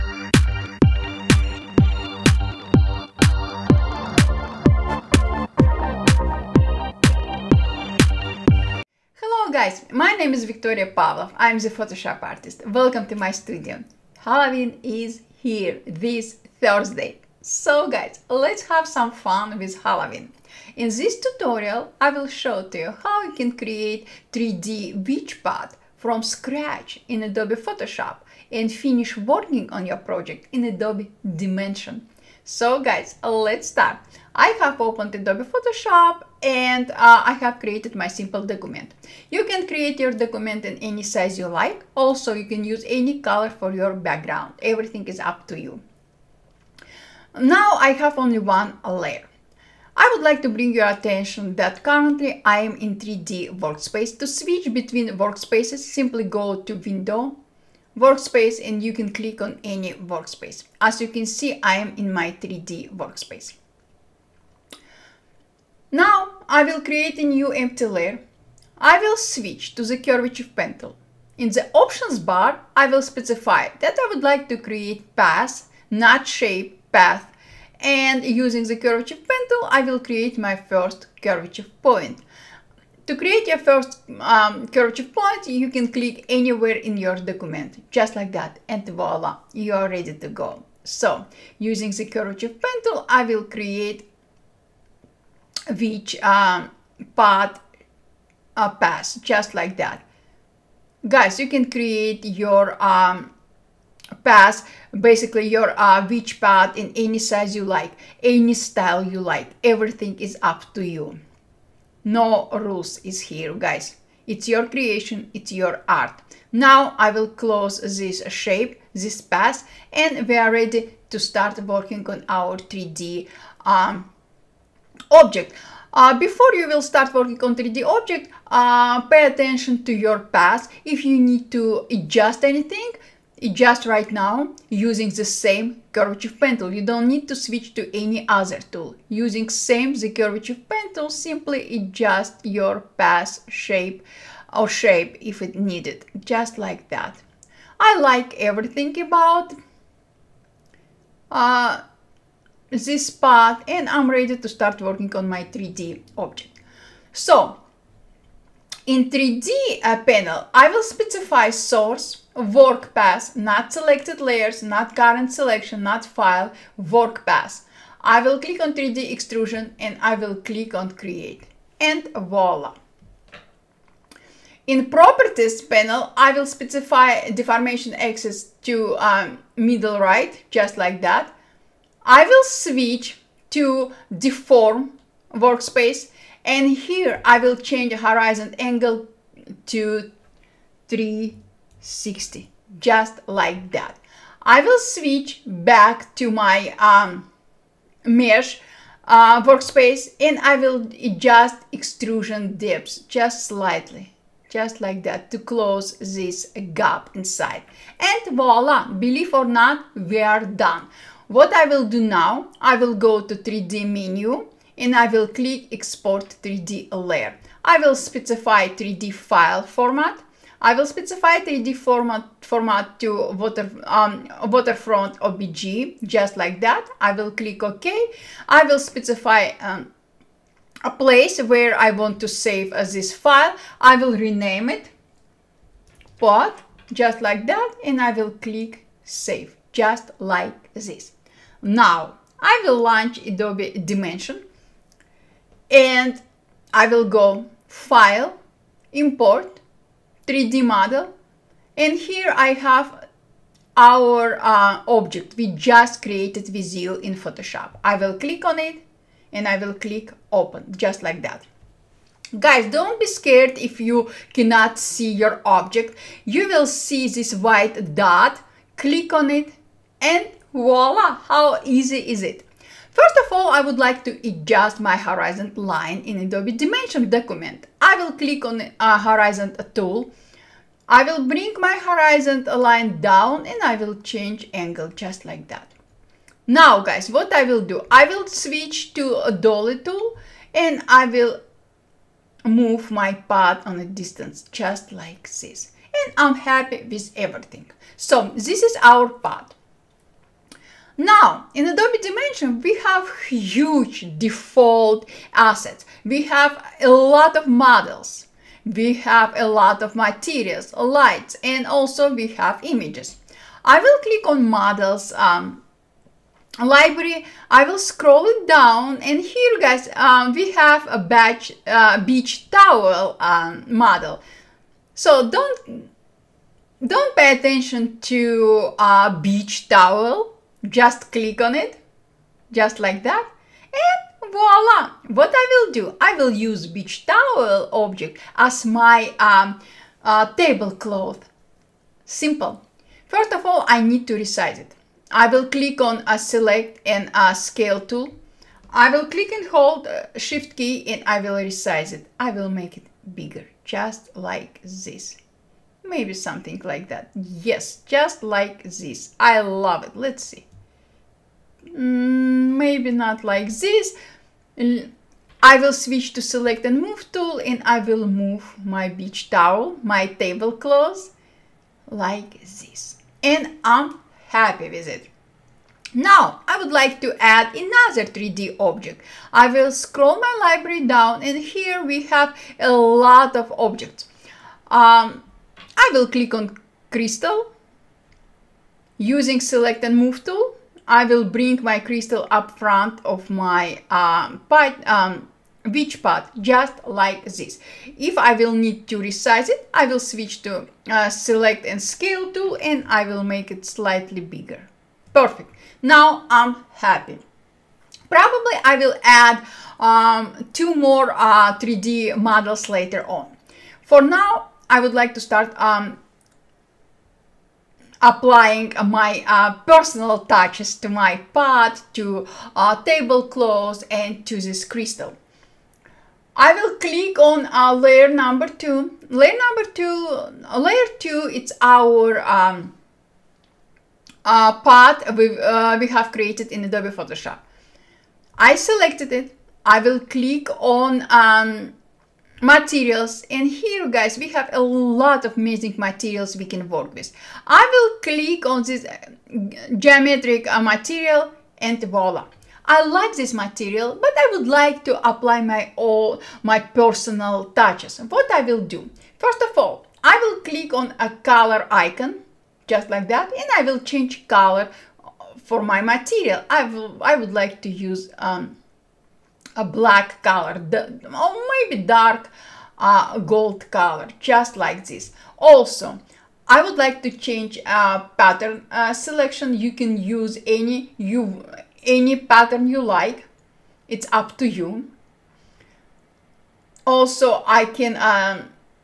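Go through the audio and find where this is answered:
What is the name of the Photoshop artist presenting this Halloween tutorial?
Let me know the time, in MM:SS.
00:10.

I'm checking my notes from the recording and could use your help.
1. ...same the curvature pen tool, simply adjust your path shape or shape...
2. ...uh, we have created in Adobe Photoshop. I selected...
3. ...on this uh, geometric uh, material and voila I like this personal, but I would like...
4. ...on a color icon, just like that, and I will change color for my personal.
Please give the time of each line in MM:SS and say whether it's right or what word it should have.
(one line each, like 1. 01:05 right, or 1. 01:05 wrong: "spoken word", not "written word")
1. 02:19 right
2. 07:15 right
3. 07:28 wrong: "material", not "personal"
4. 07:40 wrong: "material", not "personal".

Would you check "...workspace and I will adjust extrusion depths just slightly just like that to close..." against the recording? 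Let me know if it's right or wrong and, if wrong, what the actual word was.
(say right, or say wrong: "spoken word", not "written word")
right.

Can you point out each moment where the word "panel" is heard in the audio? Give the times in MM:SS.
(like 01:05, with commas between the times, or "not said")
02:40, 02:55.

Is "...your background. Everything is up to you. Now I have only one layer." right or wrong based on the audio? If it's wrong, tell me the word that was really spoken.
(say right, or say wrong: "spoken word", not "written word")
right.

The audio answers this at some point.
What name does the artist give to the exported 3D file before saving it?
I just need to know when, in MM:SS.
03:56.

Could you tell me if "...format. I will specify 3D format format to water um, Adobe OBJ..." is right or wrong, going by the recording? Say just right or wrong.
wrong.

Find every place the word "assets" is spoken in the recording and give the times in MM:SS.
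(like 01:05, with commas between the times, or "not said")
05:05.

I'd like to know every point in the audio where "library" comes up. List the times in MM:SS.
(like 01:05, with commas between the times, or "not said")
05:16, 06:20.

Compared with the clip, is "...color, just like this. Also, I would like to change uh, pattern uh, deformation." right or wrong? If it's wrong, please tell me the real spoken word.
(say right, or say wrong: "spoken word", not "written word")
wrong: "selection", not "deformation".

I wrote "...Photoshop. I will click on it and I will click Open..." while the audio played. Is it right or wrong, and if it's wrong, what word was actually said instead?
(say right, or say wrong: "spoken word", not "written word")
right.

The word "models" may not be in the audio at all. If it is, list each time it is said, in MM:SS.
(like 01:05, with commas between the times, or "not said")
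04:10, 05:07, 05:14, 05:23, 06:52.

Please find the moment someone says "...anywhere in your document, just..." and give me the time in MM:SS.
01:26.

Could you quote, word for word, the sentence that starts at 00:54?
To switch between workspaces, simply go to window, workspace, and you can click on any workspace.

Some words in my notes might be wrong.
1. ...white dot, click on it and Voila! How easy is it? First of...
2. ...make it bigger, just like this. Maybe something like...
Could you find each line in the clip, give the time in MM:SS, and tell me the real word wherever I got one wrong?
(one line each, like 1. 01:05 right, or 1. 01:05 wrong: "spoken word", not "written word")
1. 04:27 right
2. 05:52 right.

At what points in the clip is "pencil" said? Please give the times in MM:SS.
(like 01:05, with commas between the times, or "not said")
01:10, 01:19, 01:32.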